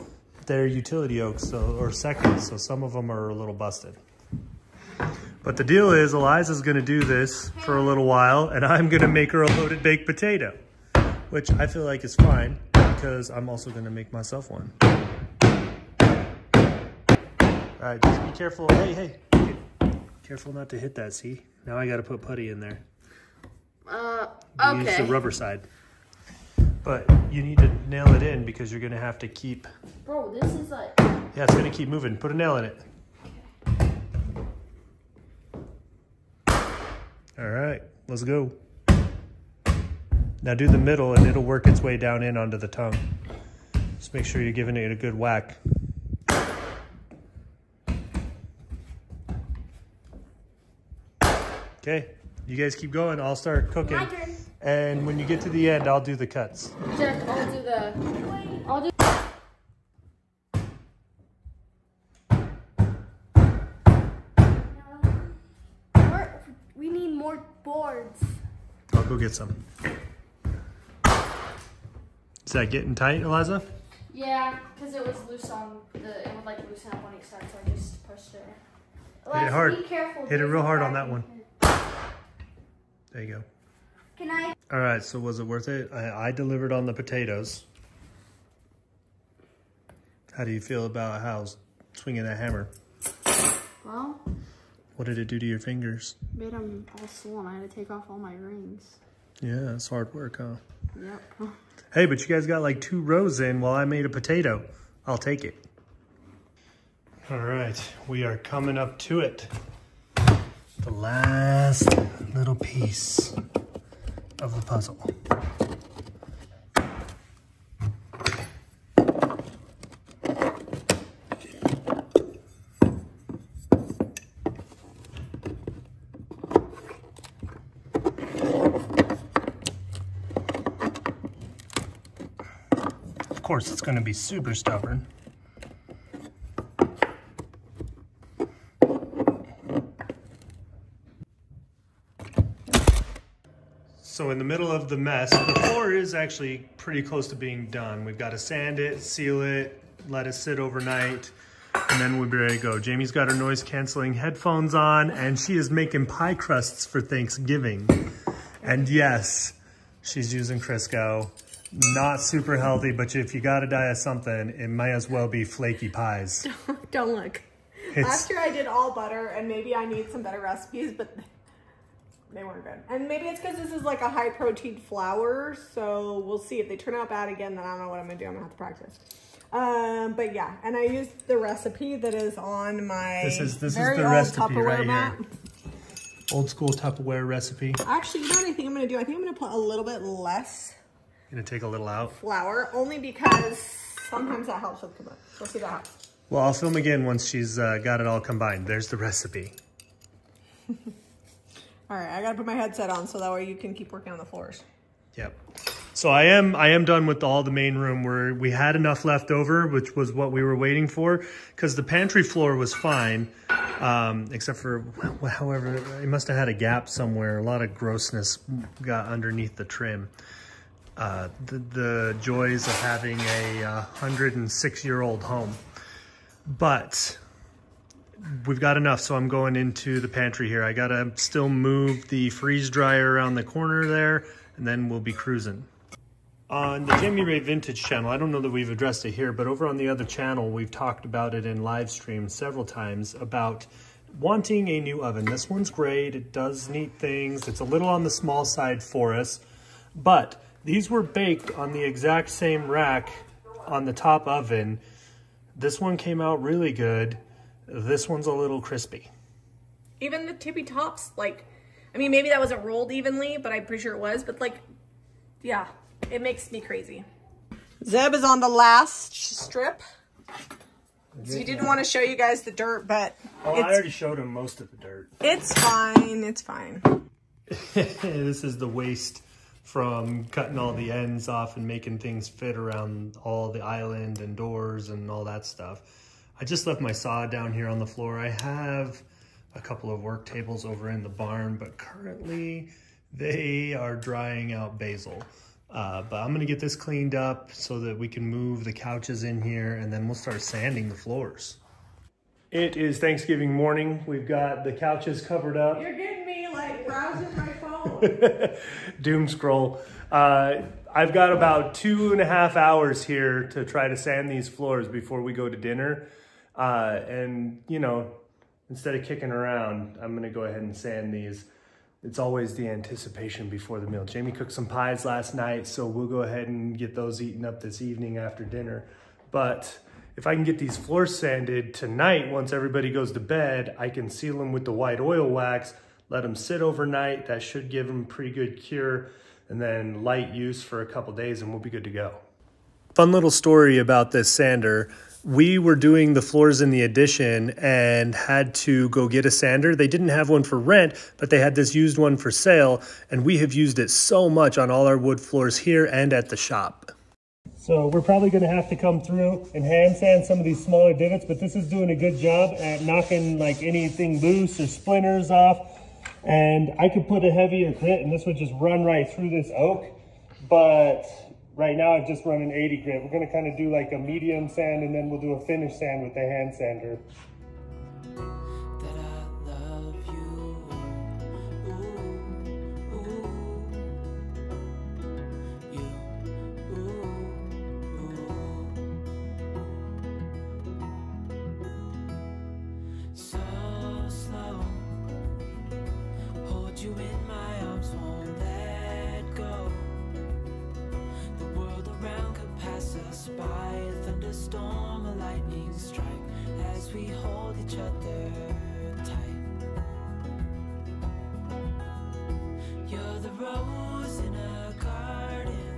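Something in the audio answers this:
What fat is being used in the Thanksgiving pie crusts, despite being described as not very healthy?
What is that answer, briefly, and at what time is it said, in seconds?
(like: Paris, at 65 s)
Crisco, at 160 s.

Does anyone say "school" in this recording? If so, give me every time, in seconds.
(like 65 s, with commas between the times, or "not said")
186 s.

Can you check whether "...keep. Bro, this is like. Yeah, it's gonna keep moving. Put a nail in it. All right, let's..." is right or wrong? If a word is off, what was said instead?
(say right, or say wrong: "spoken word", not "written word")
right.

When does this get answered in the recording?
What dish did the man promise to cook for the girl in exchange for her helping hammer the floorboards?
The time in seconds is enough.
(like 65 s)
9 s.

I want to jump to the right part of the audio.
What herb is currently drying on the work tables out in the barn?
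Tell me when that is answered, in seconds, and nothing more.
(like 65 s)
294 s.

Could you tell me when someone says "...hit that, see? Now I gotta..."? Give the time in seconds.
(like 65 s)
20 s.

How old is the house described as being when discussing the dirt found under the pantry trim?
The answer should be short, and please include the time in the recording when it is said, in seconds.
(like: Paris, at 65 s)
106 years, at 223 s.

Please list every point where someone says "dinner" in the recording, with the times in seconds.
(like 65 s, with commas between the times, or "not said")
315 s, 328 s.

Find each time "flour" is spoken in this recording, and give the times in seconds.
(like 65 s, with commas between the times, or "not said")
174 s, 192 s.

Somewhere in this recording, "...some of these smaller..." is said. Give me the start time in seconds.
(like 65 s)
360 s.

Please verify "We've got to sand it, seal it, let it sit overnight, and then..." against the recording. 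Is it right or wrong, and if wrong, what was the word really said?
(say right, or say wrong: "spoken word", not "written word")
right.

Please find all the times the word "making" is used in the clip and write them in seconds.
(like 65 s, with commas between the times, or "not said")
155 s, 281 s.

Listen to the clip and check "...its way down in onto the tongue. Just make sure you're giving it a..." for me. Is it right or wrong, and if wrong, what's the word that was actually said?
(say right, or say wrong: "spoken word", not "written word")
right.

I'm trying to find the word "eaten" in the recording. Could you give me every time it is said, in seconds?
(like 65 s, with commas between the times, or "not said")
327 s.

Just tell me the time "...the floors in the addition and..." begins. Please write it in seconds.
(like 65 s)
346 s.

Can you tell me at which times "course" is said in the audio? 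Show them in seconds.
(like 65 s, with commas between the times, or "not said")
133 s.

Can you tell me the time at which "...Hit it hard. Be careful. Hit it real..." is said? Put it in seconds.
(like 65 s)
79 s.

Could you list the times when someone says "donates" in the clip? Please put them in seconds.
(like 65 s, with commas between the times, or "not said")
not said.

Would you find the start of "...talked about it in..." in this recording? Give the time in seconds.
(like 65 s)
240 s.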